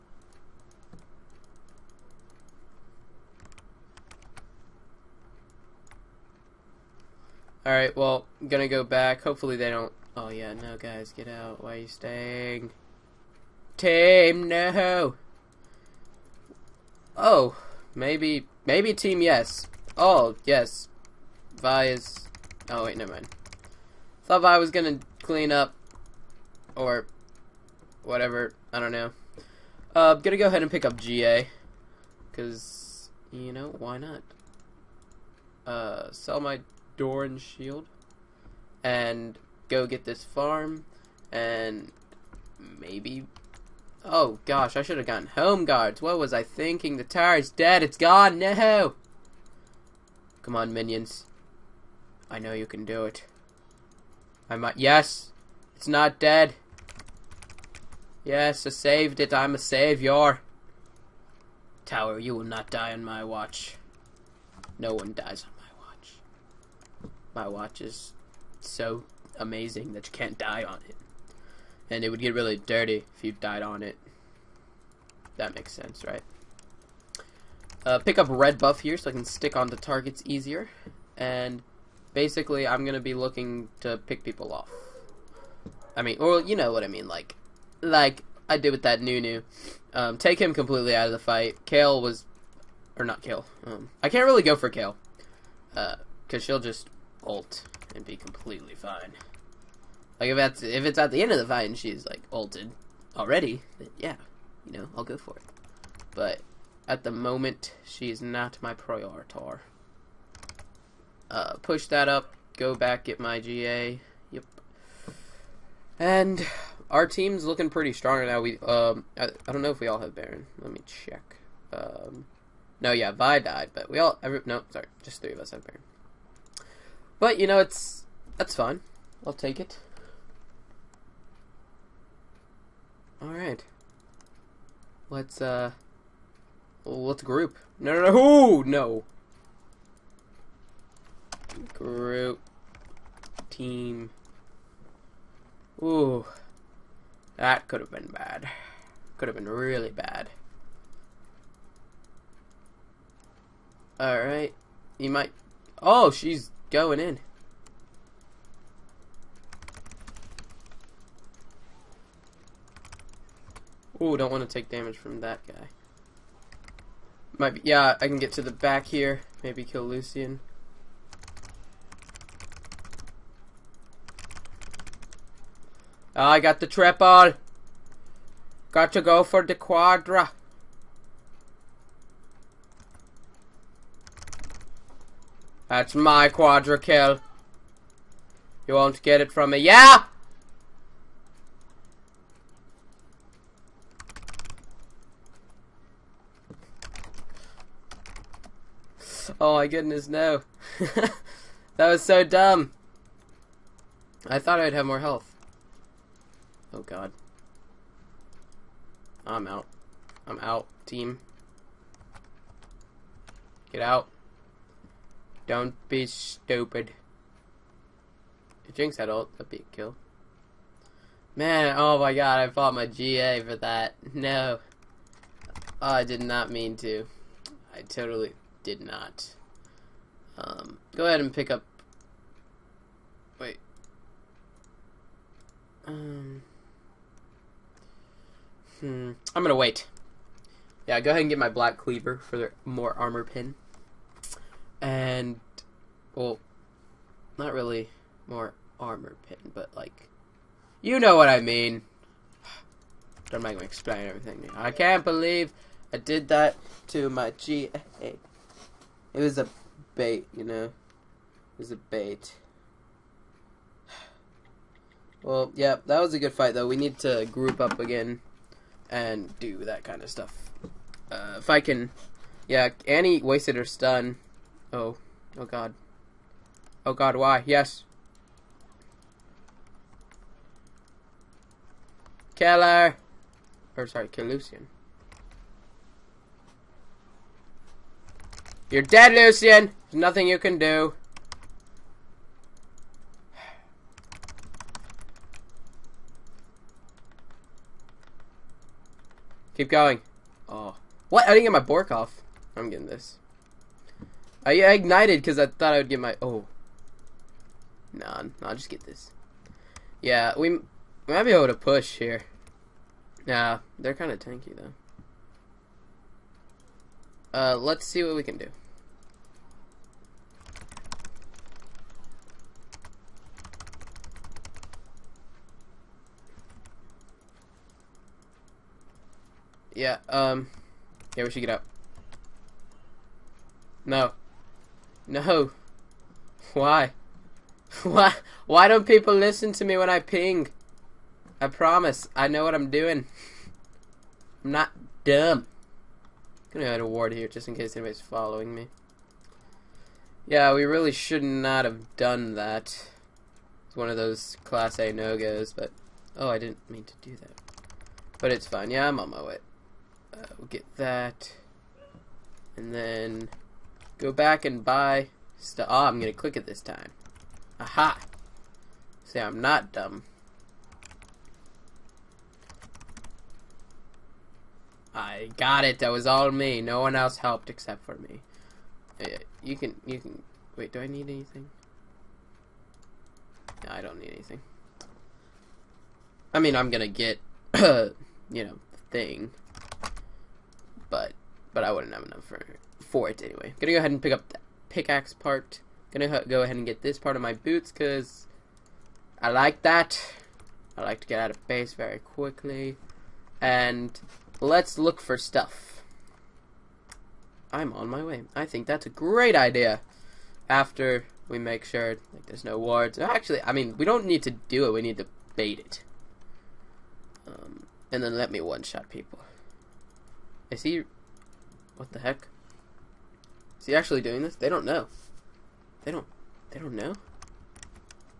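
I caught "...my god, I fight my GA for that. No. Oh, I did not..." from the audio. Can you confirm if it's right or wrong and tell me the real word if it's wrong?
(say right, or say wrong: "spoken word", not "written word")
wrong: "fought", not "fight".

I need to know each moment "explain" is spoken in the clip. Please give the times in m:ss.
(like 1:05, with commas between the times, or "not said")
4:13.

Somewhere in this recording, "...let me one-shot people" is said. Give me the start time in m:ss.
6:58.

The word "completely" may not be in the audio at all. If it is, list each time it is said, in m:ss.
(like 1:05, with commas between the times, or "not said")
1:30, 1:38.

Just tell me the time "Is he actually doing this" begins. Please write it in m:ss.
7:03.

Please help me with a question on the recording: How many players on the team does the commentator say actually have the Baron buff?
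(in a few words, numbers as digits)
3.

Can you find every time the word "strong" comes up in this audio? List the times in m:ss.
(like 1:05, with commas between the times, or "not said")
1:57.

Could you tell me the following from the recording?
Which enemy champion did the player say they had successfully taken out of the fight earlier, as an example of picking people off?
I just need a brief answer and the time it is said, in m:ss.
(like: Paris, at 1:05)
Nunu, at 1:29.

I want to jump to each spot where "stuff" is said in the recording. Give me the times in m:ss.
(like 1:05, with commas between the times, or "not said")
4:30, 6:45.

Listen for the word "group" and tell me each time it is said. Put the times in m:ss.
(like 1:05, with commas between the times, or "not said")
2:17, 2:21, 4:27.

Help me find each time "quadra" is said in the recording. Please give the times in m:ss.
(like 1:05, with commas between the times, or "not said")
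2:59, 3:06.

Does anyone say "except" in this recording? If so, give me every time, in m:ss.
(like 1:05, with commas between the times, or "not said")
6:17.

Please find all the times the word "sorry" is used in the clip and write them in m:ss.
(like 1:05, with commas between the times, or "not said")
2:04, 4:43.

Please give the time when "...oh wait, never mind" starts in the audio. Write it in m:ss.
0:22.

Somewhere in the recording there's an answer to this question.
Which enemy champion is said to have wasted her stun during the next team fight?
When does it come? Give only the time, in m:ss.
4:32.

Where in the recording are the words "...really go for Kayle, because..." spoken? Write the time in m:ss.
1:34.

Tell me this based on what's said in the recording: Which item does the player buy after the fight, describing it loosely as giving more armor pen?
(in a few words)
Black Cleaver.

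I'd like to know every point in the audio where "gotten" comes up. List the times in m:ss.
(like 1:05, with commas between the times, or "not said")
0:45.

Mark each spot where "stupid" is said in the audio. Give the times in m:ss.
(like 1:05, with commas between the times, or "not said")
3:36.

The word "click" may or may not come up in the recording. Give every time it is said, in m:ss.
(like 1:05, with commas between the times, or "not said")
6:06.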